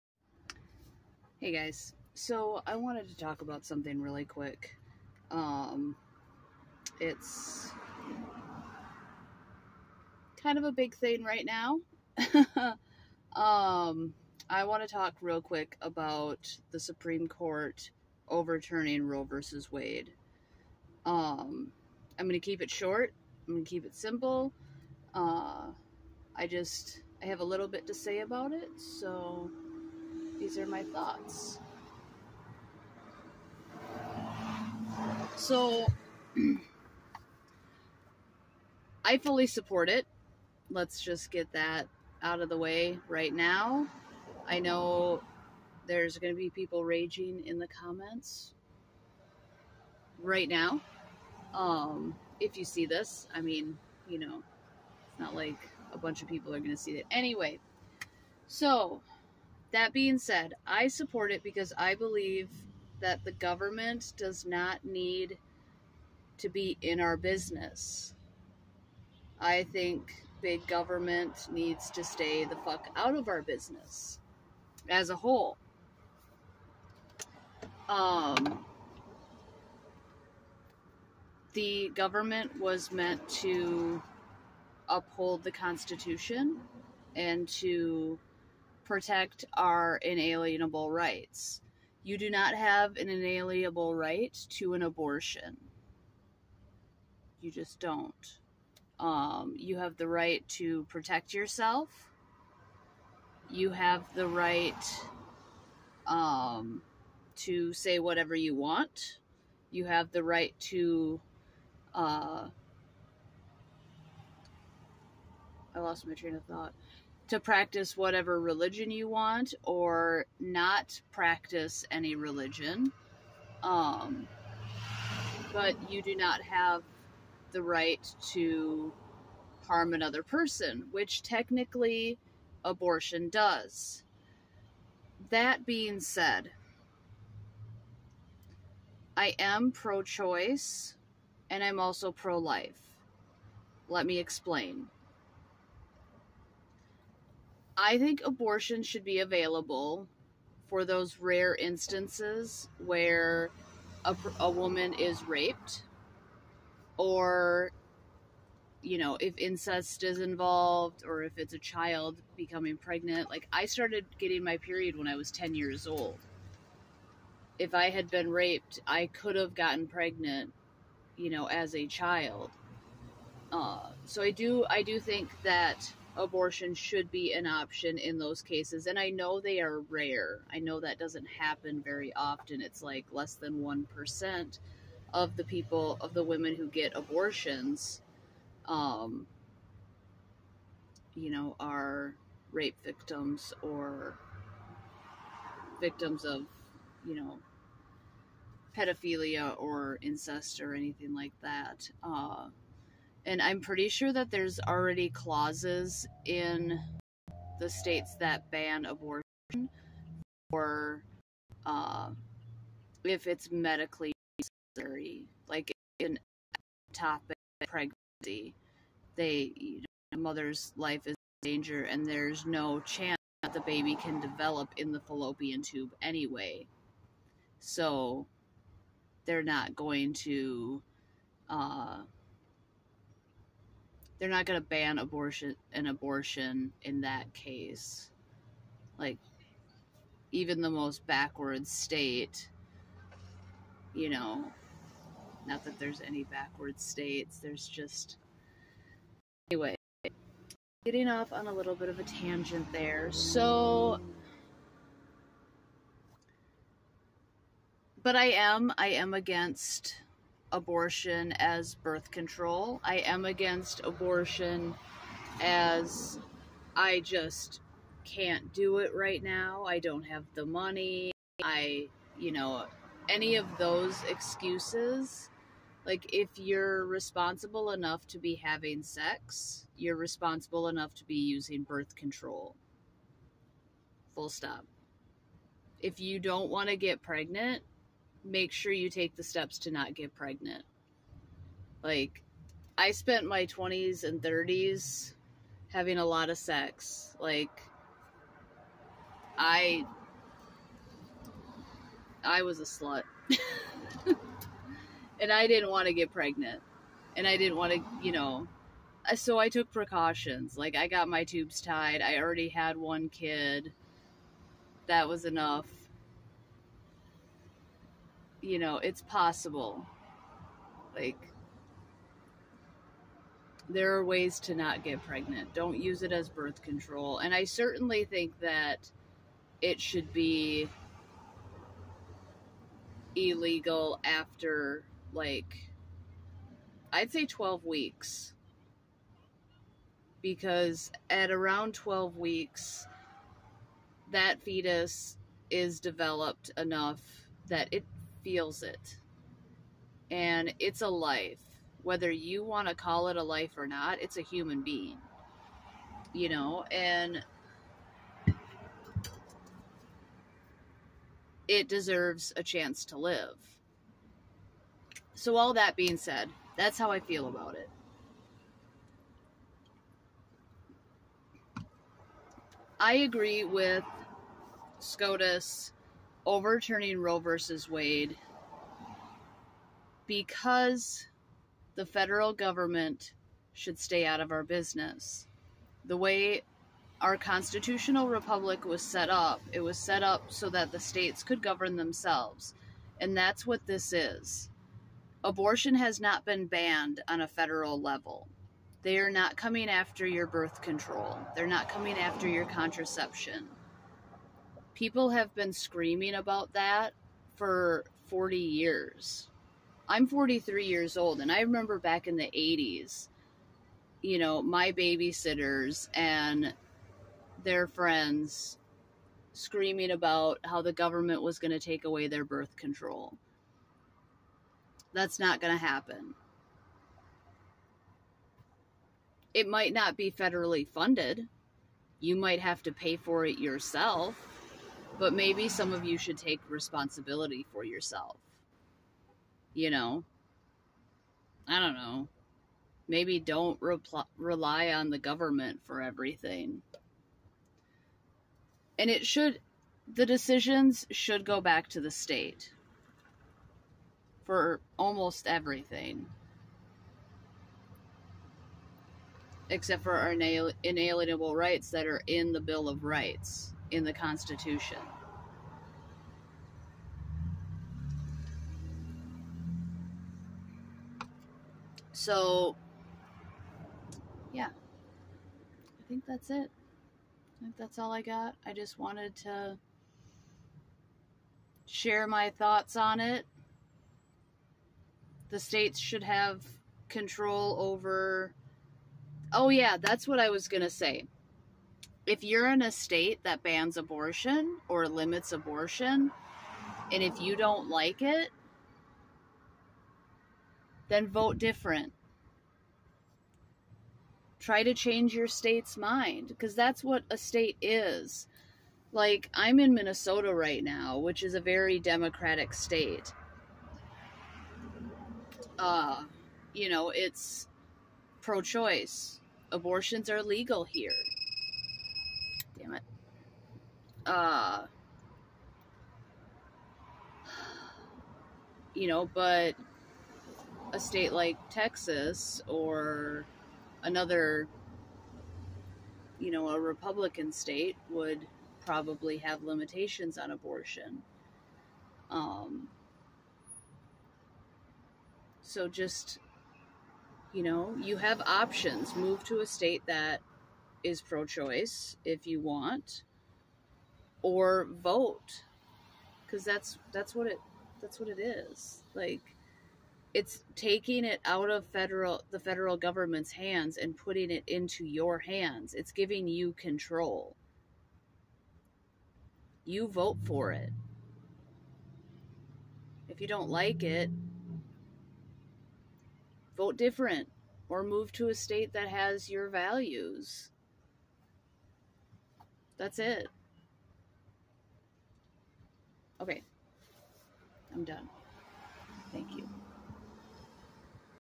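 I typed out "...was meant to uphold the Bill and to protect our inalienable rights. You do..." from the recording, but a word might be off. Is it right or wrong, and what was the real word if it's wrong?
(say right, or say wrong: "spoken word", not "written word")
wrong: "Constitution", not "Bill".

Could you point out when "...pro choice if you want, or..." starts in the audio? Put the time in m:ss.
9:11.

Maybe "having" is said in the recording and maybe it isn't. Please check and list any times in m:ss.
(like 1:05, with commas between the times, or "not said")
4:38, 4:55.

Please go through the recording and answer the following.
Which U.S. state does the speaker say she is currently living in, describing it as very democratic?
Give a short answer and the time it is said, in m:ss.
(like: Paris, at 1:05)
Minnesota, at 8:29.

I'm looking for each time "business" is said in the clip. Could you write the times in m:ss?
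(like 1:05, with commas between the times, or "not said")
1:07, 1:13, 6:24.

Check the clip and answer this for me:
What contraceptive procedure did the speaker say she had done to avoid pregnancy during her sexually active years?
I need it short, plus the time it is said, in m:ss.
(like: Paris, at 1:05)
tubes tied, at 5:10.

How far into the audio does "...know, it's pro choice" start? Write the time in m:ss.
8:36.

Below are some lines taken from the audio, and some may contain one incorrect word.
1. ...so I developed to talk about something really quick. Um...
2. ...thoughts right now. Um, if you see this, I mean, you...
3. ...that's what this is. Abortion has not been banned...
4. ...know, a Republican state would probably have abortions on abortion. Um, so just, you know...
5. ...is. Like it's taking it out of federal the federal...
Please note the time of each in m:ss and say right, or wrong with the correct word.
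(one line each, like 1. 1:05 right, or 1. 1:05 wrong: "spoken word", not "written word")
1. 0:02 wrong: "wanted", not "developed"
2. 0:47 wrong: "comments", not "thoughts"
3. 6:33 right
4. 8:56 wrong: "limitations", not "abortions"
5. 9:18 right.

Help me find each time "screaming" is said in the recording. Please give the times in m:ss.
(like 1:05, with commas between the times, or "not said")
6:45, 6:59.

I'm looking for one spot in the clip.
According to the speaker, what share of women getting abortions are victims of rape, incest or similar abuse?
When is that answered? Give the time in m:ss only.
3:03.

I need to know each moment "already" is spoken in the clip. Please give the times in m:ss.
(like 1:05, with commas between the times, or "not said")
3:24, 5:12.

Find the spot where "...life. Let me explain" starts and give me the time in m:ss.
2:22.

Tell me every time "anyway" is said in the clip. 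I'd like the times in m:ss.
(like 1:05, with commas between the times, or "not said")
0:57, 3:46, 4:09.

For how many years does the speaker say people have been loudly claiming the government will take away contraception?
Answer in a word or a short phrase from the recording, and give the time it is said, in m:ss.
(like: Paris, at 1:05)
40 years, at 6:48.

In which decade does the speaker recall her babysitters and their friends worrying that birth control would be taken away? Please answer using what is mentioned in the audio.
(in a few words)
the 80s.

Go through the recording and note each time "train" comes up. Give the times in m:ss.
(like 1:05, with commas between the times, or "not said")
1:56.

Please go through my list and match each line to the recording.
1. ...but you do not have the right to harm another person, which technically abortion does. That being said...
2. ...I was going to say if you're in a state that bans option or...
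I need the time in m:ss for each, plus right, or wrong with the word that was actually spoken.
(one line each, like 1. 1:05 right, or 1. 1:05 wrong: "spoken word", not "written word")
1. 2:05 right
2. 8:10 wrong: "abortion", not "option".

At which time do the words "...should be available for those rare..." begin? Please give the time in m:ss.
2:28.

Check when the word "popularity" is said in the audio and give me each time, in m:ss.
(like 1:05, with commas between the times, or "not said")
not said.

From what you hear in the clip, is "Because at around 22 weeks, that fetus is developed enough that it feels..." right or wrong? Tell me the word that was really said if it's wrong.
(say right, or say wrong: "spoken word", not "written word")
wrong: "12", not "22".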